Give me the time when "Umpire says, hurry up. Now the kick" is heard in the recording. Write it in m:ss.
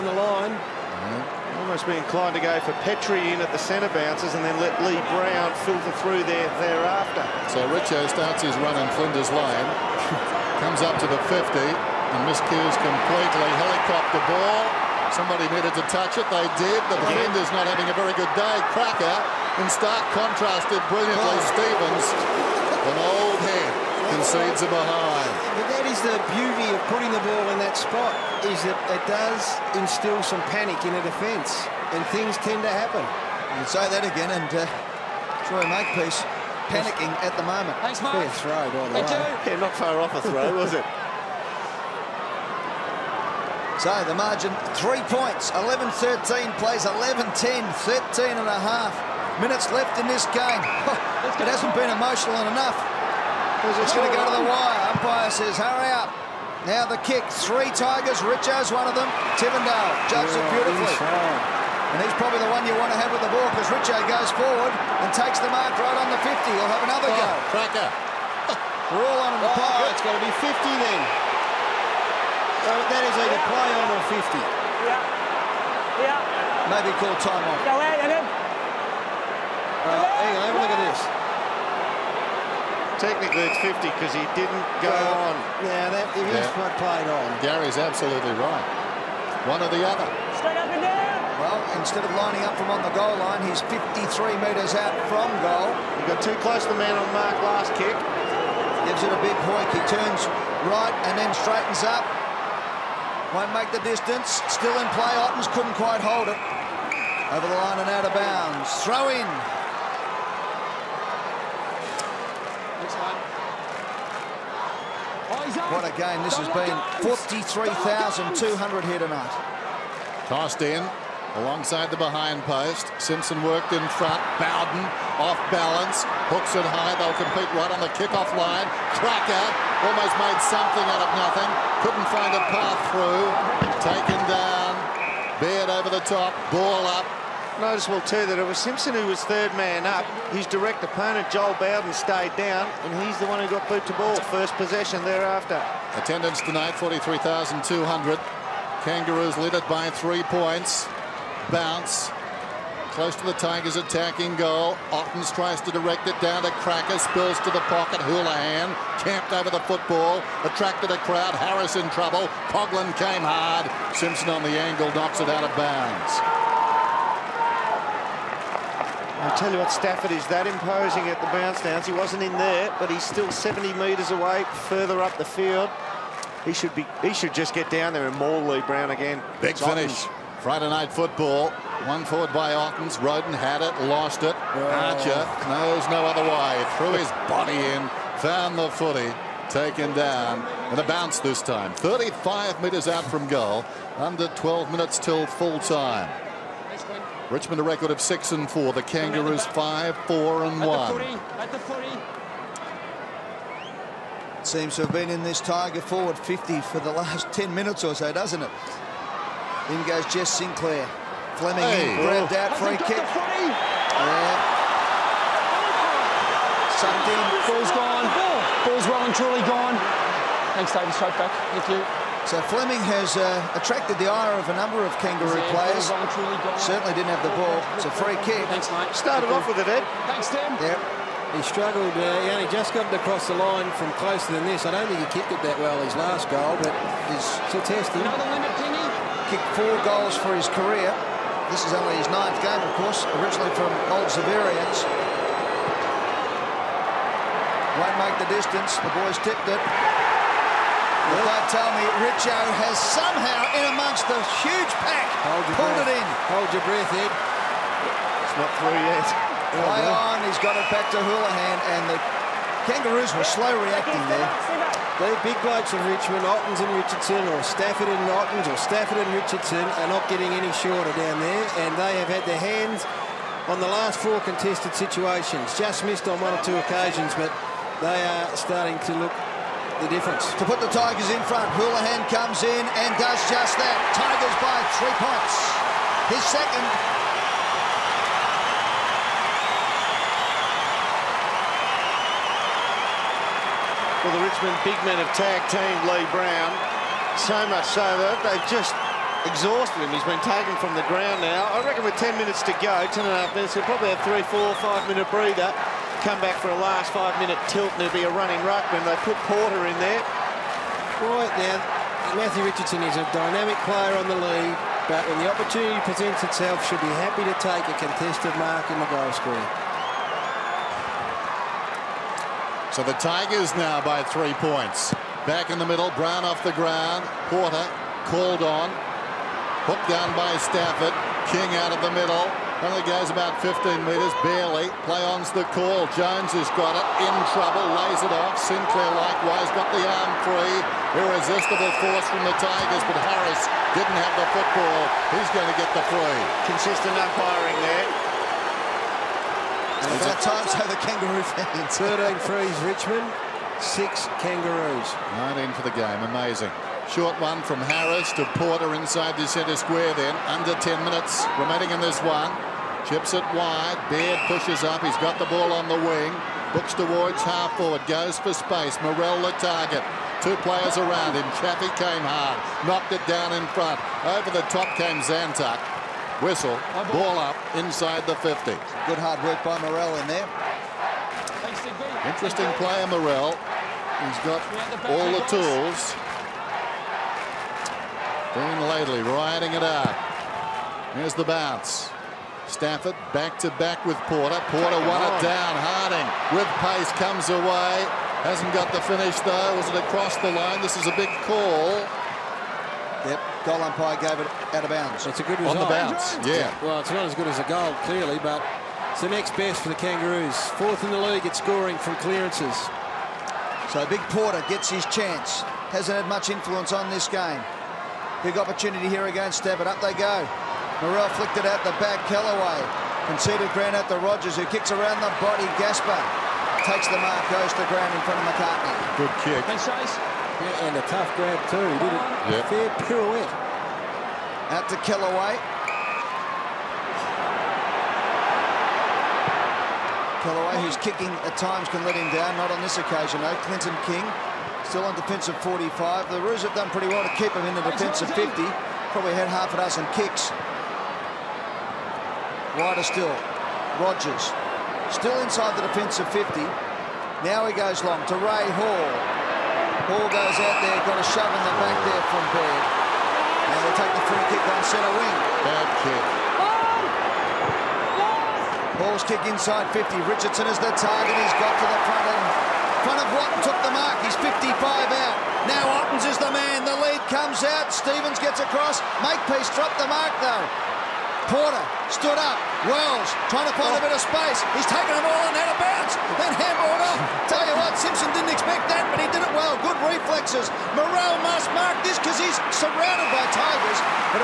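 0:54.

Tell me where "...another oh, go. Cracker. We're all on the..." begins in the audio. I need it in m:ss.
1:06.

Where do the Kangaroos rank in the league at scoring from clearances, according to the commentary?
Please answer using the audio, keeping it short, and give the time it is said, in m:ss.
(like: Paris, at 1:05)
Fourth, at 6:50.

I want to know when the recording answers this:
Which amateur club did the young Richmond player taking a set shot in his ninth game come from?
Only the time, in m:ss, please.
4:03.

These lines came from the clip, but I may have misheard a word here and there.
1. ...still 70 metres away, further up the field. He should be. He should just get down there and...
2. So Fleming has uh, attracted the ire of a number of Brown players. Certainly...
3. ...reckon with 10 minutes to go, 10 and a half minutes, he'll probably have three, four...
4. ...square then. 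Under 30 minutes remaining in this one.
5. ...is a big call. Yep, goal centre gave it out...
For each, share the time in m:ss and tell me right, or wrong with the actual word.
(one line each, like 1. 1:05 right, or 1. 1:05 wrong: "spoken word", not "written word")
1. 2:53 right
2. 3:42 wrong: "Kangaroo", not "Brown"
3. 5:01 right
4. 5:59 wrong: "10", not "30"
5. 6:40 wrong: "umpire", not "centre".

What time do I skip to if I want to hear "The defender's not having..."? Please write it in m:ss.
0:16.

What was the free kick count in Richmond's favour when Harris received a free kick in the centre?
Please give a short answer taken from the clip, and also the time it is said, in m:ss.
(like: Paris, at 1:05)
13, at 5:51.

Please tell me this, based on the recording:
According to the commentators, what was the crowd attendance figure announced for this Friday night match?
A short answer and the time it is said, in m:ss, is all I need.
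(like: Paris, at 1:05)
43,200, at 1:57.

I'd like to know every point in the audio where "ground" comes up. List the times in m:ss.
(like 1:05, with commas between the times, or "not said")
5:00, 5:26, 7:03, 7:07.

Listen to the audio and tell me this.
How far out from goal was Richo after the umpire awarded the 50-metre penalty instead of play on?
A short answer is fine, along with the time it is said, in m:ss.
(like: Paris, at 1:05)
53 metres, at 1:33.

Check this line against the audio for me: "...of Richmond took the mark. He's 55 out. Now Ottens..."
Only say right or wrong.
wrong.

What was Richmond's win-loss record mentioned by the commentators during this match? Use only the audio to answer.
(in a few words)
six and four.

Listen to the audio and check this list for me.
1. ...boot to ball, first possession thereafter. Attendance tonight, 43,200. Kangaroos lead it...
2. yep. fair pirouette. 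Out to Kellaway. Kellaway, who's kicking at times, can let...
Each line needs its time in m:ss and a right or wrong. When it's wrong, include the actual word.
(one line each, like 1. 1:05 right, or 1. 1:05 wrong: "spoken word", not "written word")
1. 2:23 right
2. 7:12 right.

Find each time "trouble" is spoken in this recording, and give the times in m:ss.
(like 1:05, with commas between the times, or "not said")
2:41, 5:37.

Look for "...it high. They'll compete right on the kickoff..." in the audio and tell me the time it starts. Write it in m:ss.
2:06.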